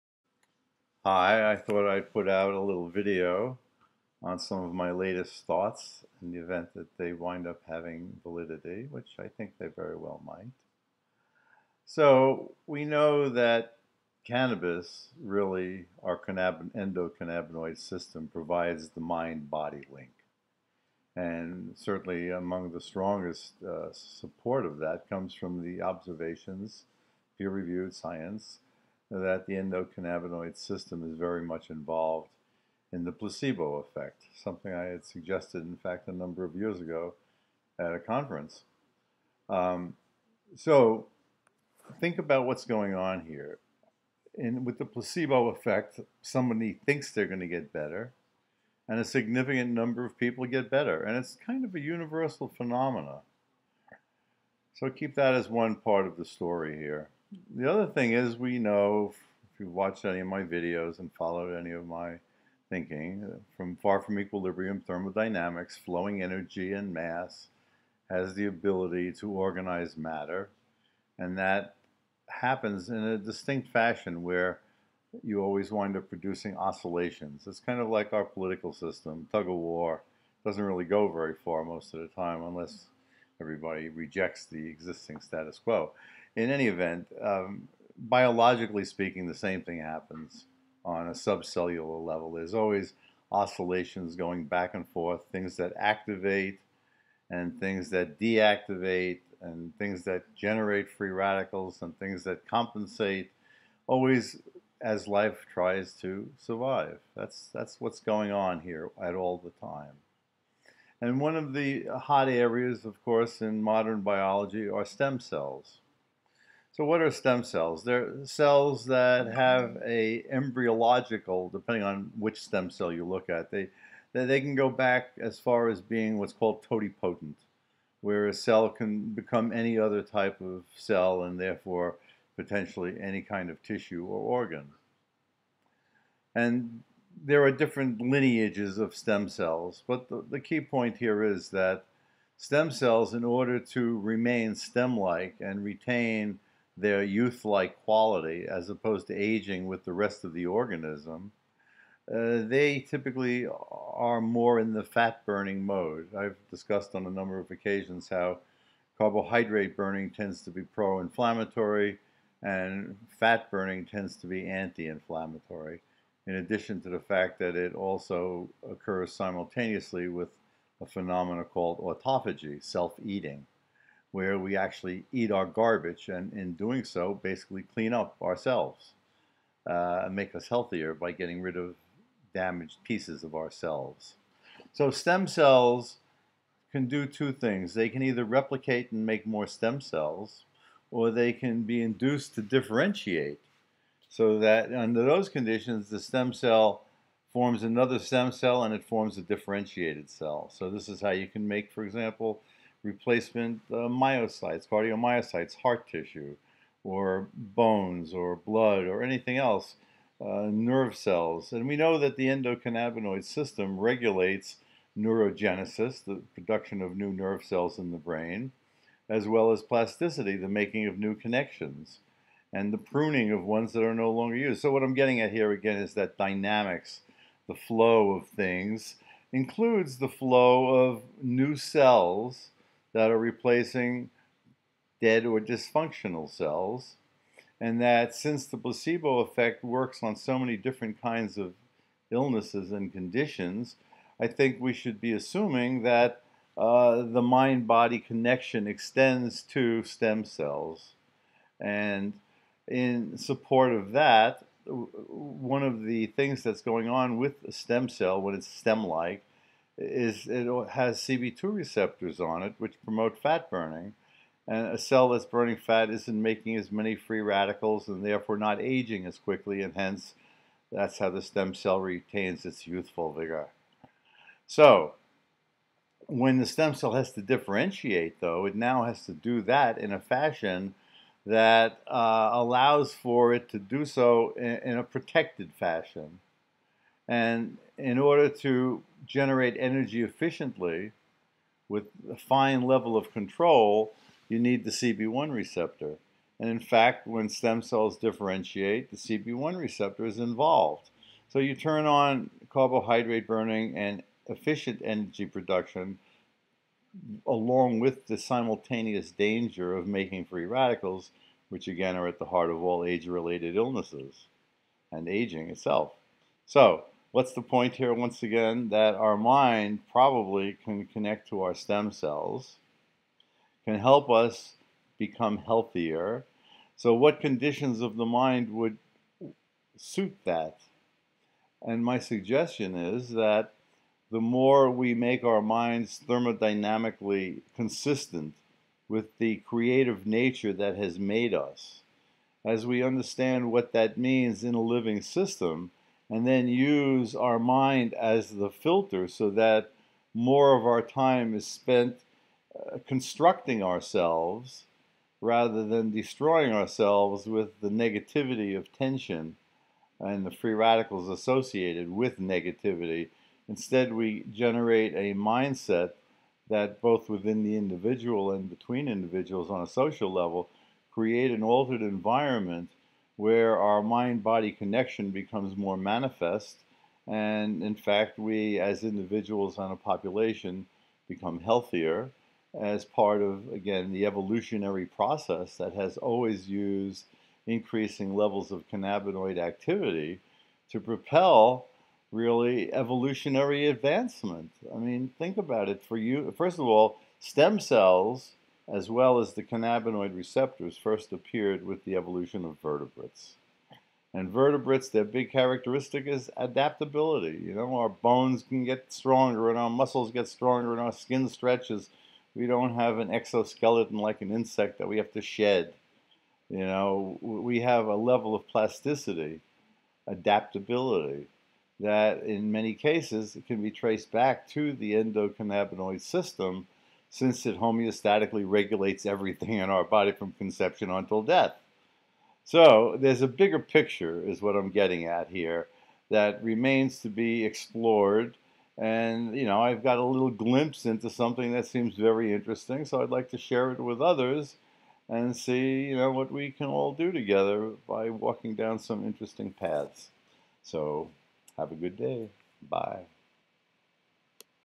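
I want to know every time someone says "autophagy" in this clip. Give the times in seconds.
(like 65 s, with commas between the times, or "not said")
171 s.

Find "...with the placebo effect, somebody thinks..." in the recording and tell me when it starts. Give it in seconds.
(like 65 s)
44 s.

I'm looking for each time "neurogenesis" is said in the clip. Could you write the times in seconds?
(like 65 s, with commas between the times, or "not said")
214 s.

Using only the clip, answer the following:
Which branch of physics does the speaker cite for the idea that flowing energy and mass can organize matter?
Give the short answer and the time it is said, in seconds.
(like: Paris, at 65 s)
far from equilibrium thermodynamics, at 63 s.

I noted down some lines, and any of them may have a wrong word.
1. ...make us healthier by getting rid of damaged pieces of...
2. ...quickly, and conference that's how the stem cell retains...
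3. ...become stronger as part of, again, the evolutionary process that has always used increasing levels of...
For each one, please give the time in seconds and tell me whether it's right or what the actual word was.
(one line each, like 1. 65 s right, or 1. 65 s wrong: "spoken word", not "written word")
1. 180 s right
2. 269 s wrong: "hence", not "conference"
3. 381 s wrong: "healthier", not "stronger".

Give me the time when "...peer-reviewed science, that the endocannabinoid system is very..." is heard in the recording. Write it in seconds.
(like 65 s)
27 s.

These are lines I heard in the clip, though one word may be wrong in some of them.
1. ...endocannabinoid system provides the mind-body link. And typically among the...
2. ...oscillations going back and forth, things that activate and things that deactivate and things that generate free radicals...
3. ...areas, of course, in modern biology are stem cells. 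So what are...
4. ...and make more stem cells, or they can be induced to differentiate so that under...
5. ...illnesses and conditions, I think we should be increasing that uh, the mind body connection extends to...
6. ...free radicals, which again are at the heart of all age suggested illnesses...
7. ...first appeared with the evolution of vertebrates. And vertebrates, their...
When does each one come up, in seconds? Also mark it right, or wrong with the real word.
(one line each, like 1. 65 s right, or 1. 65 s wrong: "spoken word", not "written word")
1. 16 s wrong: "certainly", not "typically"
2. 93 s right
3. 112 s right
4. 188 s right
5. 242 s wrong: "assuming", not "increasing"
6. 310 s wrong: "related", not "suggested"
7. 400 s right.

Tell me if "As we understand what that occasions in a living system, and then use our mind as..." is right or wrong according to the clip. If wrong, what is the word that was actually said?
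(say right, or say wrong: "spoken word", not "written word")
wrong: "means", not "occasions".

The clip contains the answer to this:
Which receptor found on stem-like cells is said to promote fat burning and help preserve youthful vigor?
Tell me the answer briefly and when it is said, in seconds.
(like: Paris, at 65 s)
CB2, at 260 s.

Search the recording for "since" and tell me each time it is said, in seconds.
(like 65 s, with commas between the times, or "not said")
238 s, 427 s.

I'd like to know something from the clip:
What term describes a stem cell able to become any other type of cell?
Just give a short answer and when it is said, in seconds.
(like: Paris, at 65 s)
totipotent, at 126 s.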